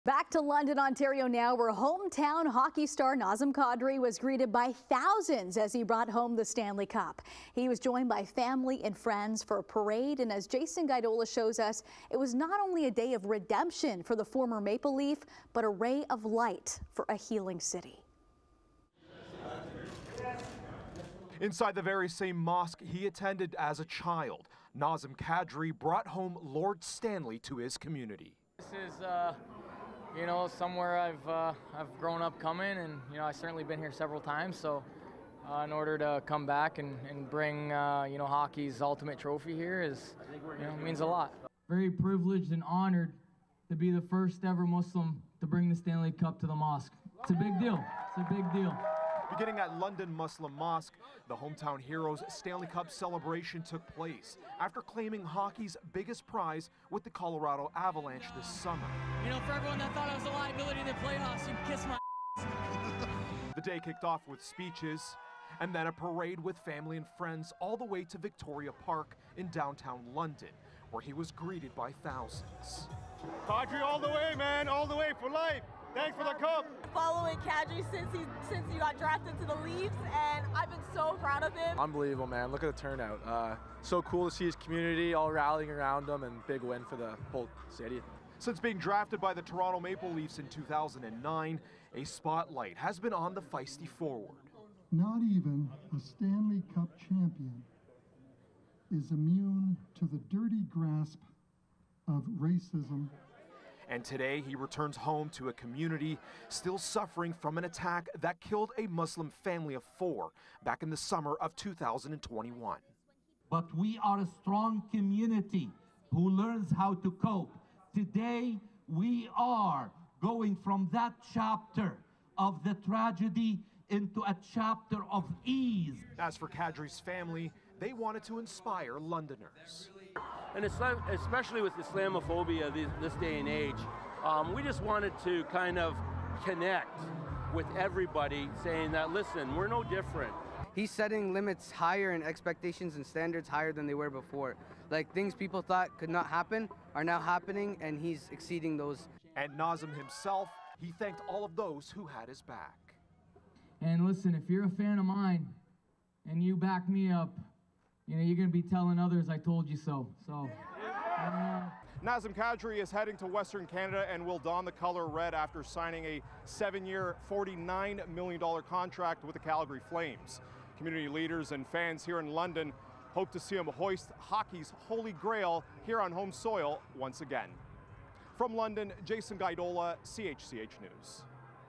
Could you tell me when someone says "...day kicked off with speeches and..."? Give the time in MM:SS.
01:03.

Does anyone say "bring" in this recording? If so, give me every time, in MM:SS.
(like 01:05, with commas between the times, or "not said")
00:37, 00:45.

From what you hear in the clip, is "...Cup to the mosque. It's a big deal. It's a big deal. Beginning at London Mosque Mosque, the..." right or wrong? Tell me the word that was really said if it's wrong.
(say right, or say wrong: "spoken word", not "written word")
wrong: "Muslim", not "Mosque".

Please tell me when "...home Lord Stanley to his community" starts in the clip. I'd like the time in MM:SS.
00:26.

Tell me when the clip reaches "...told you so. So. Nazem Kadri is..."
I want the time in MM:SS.
02:39.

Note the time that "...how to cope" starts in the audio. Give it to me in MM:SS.
01:56.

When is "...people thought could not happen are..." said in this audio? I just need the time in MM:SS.
02:25.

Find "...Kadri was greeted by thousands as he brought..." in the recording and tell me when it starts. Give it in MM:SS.
00:03.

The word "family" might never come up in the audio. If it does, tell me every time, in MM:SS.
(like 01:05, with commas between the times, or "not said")
00:08, 01:06, 01:49, 02:07.